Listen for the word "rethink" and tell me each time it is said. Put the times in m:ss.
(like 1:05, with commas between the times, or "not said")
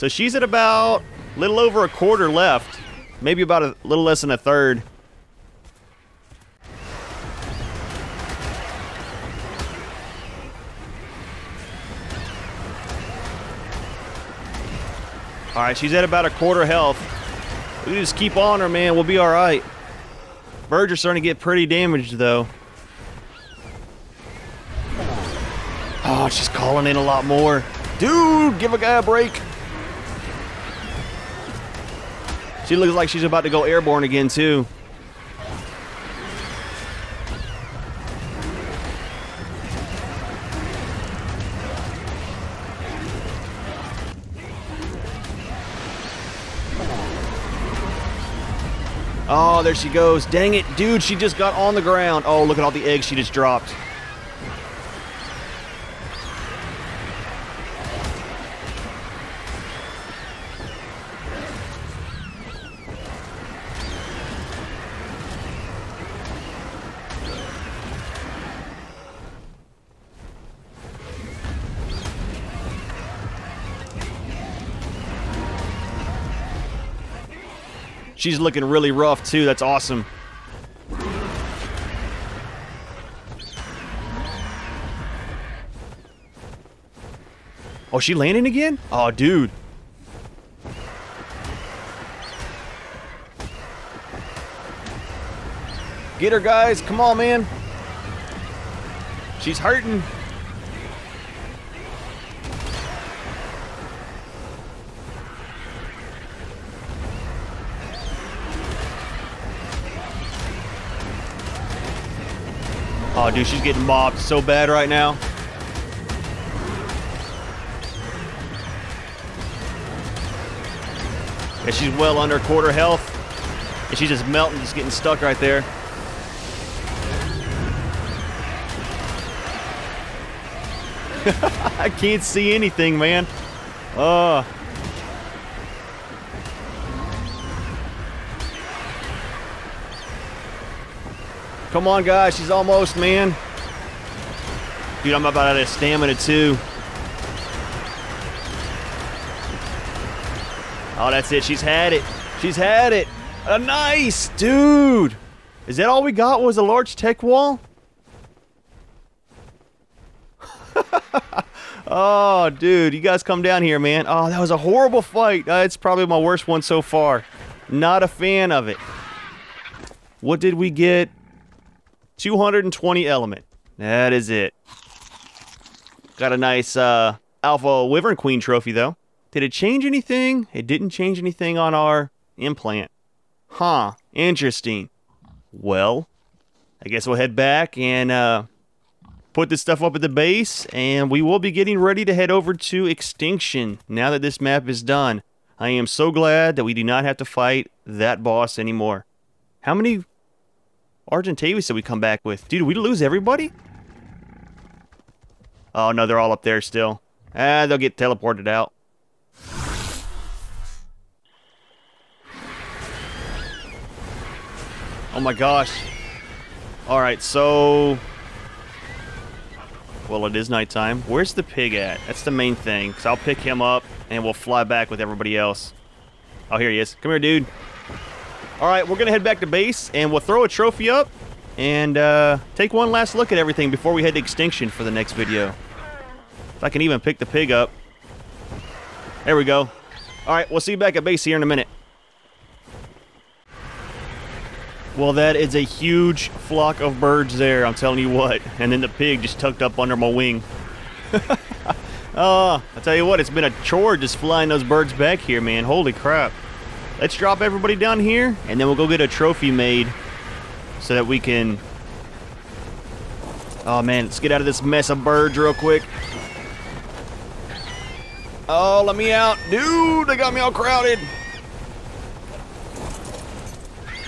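not said.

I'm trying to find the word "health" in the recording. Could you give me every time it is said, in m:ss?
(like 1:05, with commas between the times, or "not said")
0:16, 2:02.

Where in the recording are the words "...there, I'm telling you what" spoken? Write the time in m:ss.
4:07.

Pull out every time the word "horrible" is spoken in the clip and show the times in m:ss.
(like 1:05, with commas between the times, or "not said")
2:44.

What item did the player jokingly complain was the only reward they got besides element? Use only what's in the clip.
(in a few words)
large Tek wall.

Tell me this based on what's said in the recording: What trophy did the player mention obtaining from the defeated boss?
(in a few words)
Alpha Wyvern Queen trophy.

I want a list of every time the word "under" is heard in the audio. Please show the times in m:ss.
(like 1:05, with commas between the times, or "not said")
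2:02, 4:09.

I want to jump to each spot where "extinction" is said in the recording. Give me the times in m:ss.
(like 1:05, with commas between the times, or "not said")
3:12, 3:54.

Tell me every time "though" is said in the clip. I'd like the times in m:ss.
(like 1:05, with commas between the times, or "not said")
0:22, 2:58.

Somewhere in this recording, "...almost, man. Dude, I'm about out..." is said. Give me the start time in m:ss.
2:22.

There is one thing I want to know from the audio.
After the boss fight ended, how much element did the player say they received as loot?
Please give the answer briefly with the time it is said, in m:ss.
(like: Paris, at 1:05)
220, at 2:52.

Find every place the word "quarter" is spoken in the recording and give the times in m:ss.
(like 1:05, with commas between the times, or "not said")
0:01, 0:16, 2:02.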